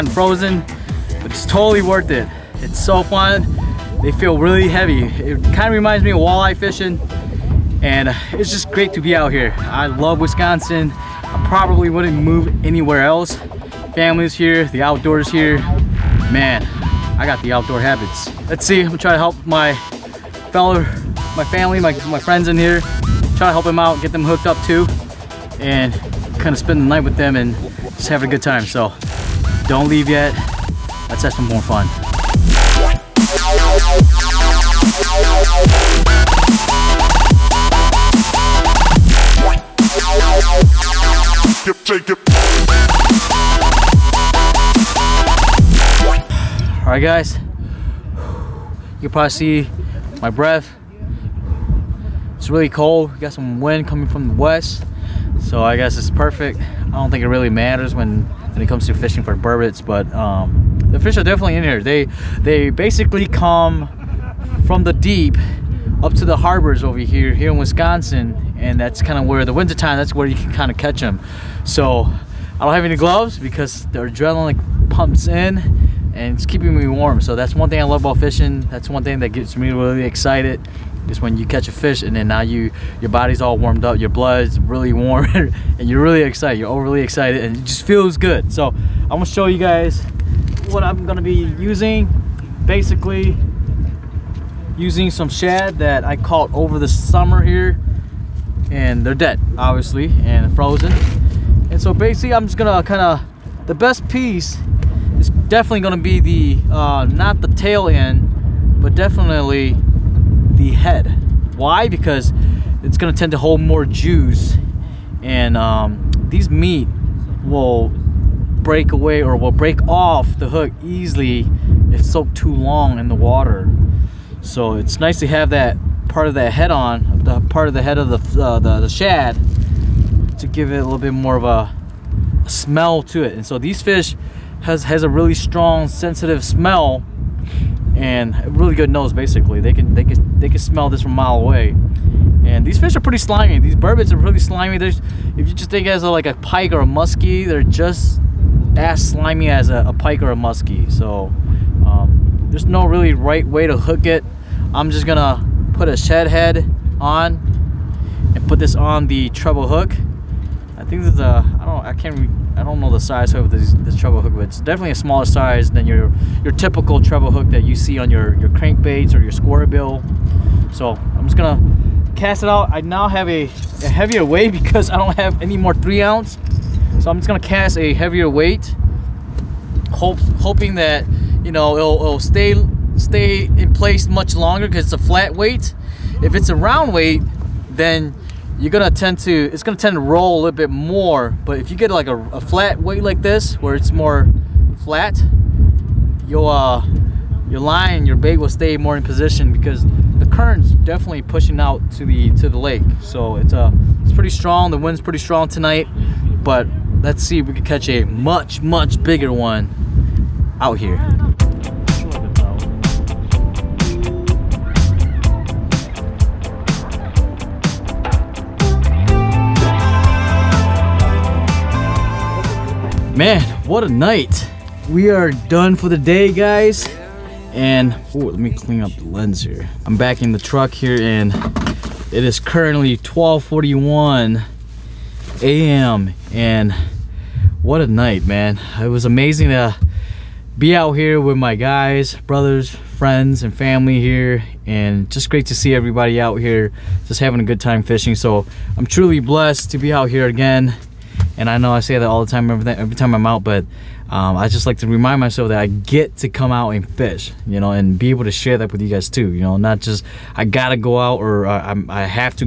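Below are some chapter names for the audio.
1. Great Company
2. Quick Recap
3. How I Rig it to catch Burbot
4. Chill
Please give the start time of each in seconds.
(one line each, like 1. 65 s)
1. 210 s
2. 222 s
3. 88 s
4. 30 s.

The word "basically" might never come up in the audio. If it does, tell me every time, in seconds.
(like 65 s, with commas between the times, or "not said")
62 s, 92 s, 101 s, 139 s.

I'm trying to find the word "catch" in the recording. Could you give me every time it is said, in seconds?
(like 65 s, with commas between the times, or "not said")
70 s, 81 s, 207 s.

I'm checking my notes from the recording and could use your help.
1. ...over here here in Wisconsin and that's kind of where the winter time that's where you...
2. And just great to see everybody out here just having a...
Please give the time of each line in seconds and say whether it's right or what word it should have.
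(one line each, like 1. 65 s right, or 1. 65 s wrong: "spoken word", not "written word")
1. 66 s right
2. 244 s right.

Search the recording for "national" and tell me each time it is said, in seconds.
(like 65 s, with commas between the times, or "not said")
not said.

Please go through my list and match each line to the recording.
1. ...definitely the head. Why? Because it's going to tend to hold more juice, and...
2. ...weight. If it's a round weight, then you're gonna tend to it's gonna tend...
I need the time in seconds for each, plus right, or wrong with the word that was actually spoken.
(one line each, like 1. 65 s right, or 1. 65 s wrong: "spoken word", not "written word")
1. 108 s right
2. 185 s right.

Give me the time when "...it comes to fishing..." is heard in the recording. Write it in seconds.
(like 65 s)
58 s.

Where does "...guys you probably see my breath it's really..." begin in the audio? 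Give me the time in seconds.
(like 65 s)
47 s.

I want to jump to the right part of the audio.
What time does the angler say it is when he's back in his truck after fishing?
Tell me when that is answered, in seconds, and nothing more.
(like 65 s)
232 s.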